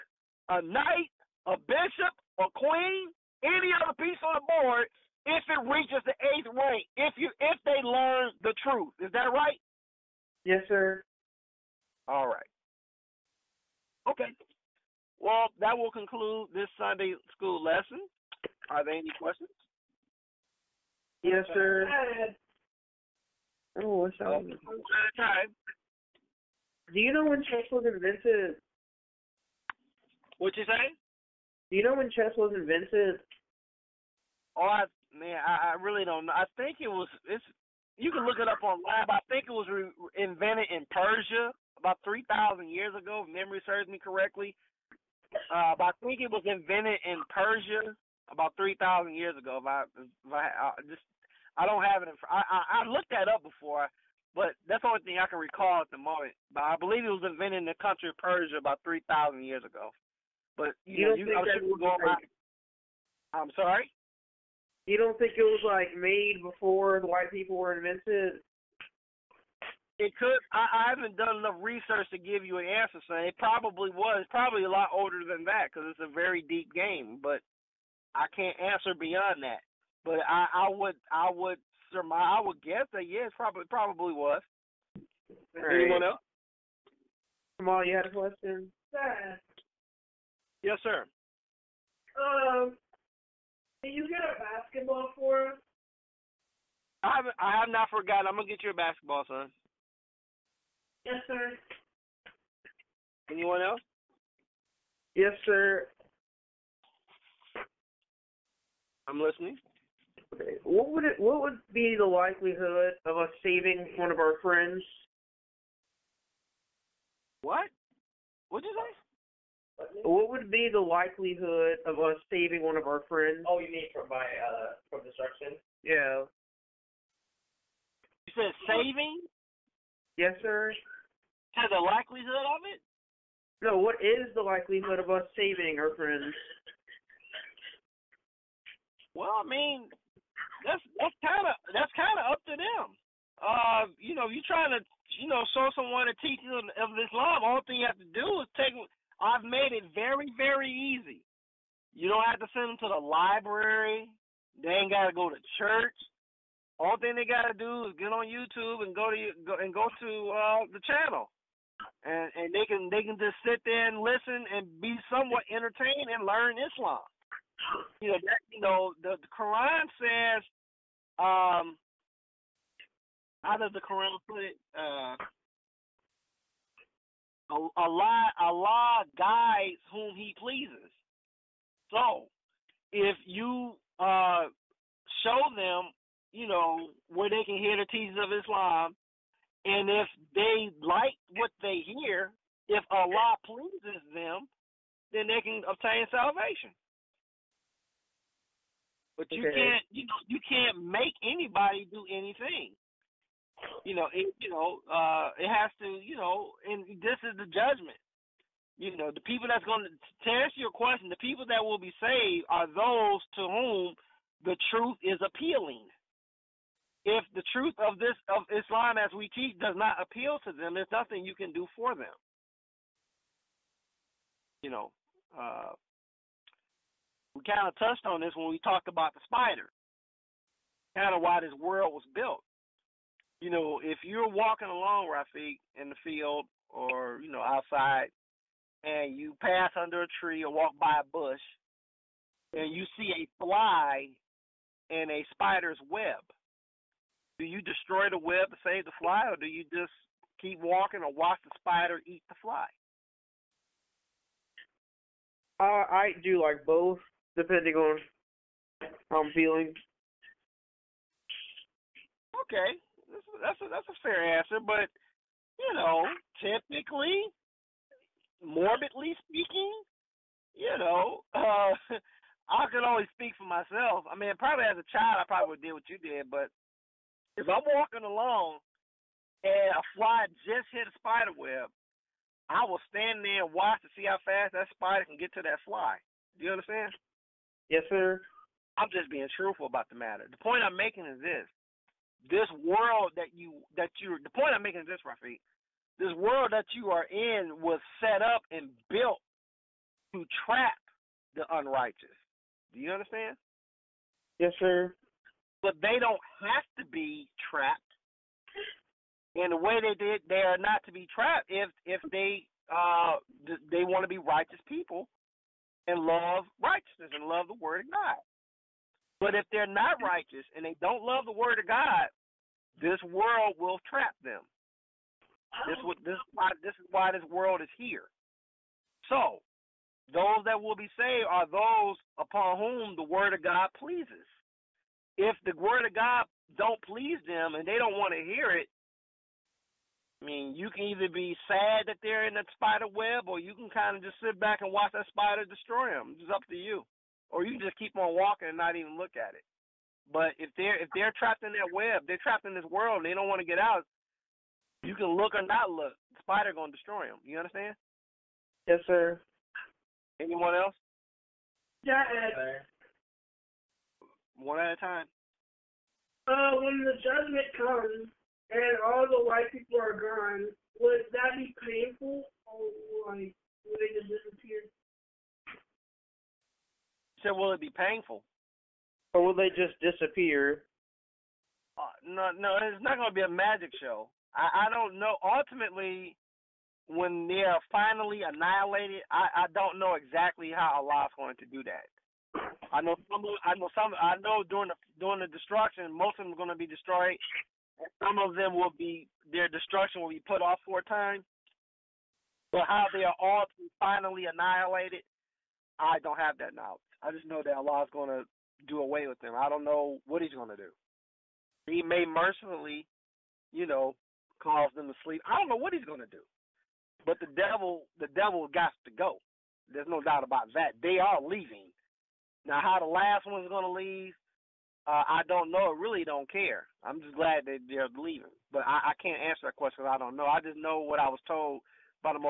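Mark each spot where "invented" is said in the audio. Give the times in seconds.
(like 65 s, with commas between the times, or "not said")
27 s, 32 s, 40 s, 46 s, 57 s, 67 s.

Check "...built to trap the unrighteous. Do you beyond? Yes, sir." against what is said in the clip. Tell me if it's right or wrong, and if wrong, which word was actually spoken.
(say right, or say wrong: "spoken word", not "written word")
wrong: "understand", not "beyond".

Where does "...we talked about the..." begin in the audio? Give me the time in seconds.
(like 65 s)
228 s.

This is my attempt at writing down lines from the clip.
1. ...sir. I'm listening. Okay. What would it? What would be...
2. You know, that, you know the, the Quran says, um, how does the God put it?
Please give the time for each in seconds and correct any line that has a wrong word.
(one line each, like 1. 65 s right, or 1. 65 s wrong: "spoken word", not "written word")
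1. 105 s right
2. 168 s wrong: "Quran", not "God".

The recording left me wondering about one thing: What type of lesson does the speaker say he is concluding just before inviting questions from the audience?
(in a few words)
Sunday school lesson.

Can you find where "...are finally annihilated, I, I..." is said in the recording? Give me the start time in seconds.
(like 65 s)
387 s.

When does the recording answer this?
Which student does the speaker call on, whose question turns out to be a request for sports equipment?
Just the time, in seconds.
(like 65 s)
87 s.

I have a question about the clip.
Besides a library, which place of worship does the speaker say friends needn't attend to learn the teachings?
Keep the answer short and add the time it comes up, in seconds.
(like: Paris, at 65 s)
church, at 155 s.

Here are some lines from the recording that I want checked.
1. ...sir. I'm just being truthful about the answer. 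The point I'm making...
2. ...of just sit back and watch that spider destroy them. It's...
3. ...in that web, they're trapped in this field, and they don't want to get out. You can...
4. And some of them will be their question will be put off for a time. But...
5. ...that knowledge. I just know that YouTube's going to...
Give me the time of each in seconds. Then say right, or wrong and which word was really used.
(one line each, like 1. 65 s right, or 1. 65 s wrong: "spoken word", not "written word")
1. 287 s wrong: "matter", not "answer"
2. 343 s right
3. 351 s wrong: "world", not "field"
4. 397 s wrong: "destruction", not "question"
5. 406 s wrong: "Allah", not "YouTube".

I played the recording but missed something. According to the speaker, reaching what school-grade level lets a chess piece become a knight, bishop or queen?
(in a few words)
eighth grade.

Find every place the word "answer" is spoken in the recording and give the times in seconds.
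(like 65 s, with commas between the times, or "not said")
72 s, 78 s, 210 s, 264 s, 429 s.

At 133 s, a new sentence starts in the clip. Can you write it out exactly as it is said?
No, what is the likelihood of us saving our friends?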